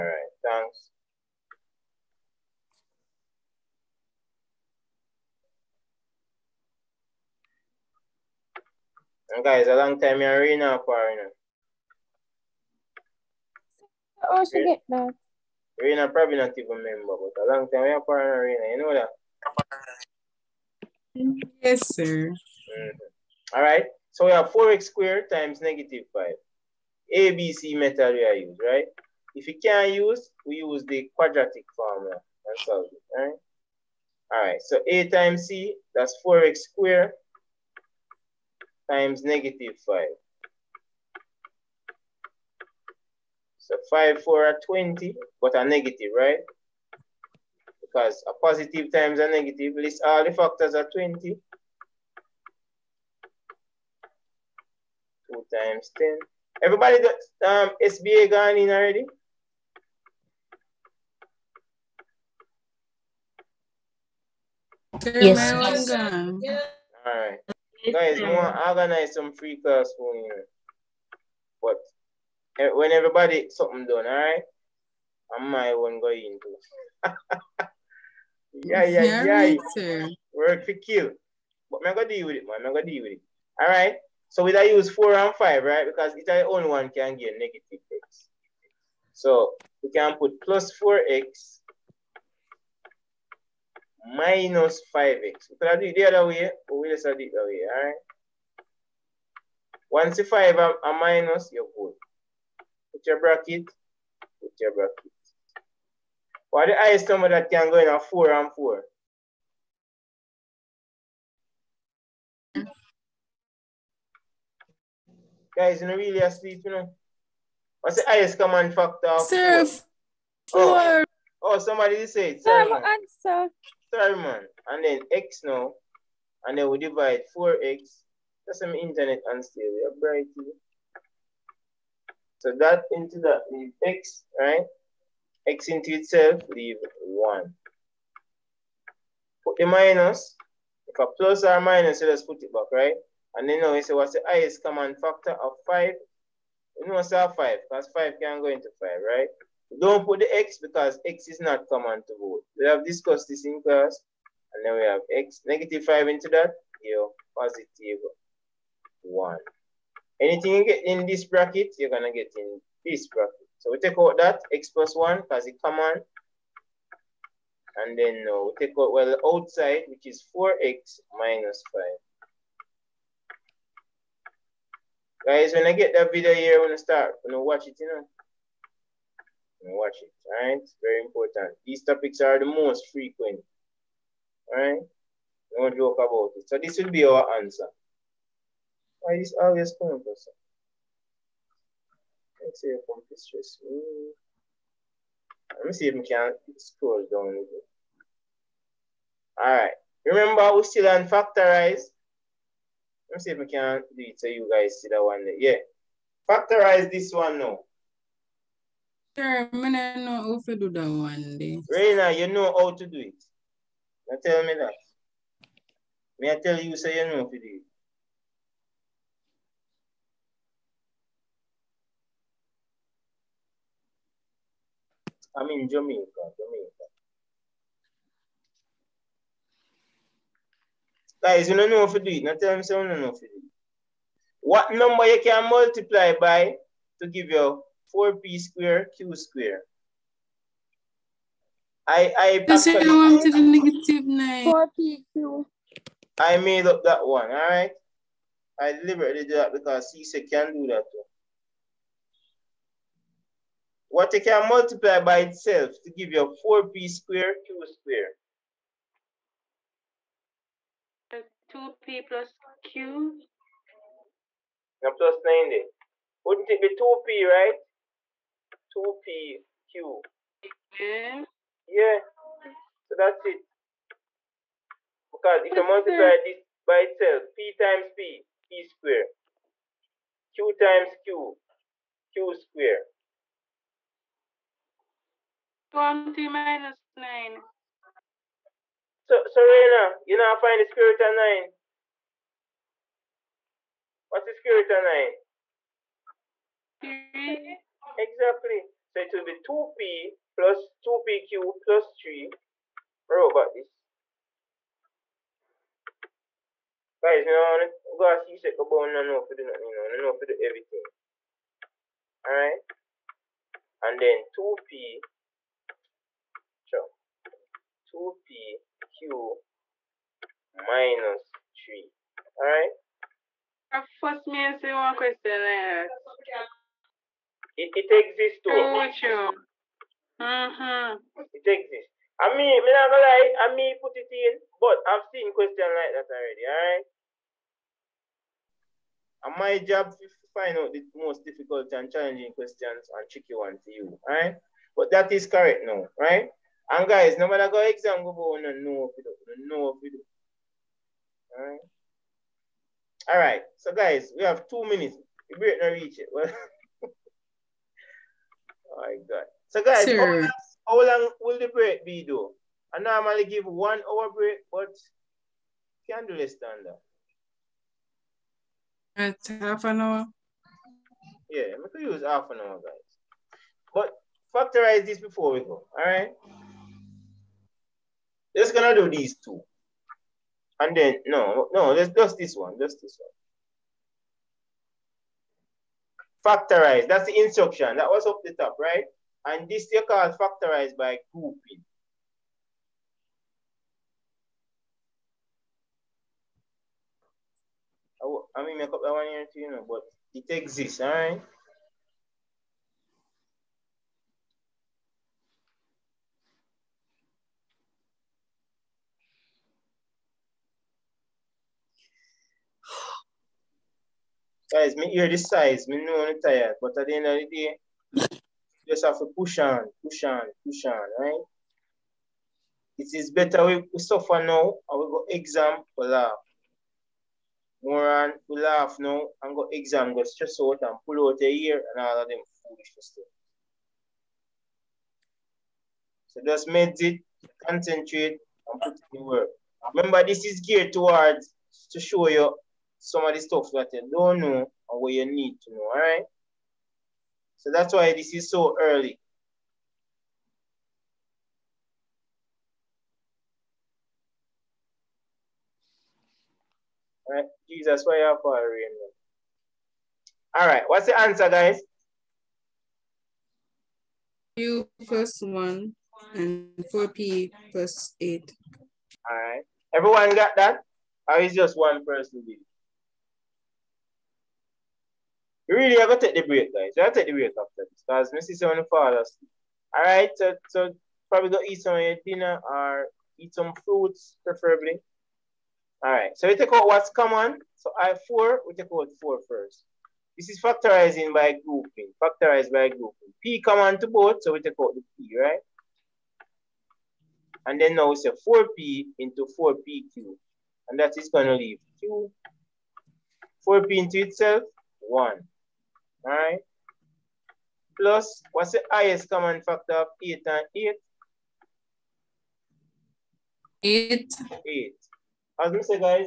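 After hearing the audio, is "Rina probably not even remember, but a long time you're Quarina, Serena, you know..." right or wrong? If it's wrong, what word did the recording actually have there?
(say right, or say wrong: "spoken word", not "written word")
wrong: "Rina", not "Serena".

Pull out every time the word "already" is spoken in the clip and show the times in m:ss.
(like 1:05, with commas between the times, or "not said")
0:58, 5:36.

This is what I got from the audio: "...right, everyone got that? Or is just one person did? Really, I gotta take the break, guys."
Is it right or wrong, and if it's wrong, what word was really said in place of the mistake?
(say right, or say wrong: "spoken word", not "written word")
right.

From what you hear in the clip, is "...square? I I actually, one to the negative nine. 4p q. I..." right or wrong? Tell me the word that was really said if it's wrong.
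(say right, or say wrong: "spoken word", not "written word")
right.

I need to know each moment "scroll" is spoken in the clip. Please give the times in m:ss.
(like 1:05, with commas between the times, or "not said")
3:16.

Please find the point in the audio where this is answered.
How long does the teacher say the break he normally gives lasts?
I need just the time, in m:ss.
6:03.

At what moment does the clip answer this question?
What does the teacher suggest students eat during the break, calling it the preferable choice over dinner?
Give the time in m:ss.
8:03.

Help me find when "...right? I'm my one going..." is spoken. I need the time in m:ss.
1:14.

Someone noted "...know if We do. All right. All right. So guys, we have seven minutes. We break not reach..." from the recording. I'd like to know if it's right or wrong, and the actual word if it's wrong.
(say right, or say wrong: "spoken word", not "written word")
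wrong: "two", not "seven".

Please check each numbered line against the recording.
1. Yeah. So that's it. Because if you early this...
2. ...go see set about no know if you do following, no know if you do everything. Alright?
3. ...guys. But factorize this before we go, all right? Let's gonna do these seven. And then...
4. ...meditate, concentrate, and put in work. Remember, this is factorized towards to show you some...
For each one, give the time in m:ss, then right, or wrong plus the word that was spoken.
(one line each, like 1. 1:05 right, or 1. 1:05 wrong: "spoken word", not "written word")
1. 4:31 wrong: "multiply", not "early"
2. 5:08 wrong: "nothing", not "following"
3. 6:12 wrong: "two", not "seven"
4. 7:16 wrong: "geared", not "factorized".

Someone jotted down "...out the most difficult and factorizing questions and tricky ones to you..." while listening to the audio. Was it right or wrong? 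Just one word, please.
wrong.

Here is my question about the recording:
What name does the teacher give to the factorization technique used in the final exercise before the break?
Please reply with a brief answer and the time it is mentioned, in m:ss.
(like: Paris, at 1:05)
factorize by grouping, at 6:30.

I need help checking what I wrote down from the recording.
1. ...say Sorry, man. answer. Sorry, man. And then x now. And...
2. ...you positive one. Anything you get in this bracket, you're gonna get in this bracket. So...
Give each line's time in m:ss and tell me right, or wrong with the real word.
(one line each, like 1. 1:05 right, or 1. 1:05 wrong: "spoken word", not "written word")
1. 2:02 right
2. 2:36 right.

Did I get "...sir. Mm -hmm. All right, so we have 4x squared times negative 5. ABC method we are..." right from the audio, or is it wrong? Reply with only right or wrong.
right.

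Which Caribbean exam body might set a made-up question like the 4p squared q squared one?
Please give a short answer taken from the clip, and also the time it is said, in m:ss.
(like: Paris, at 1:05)
CSEC, at 4:09.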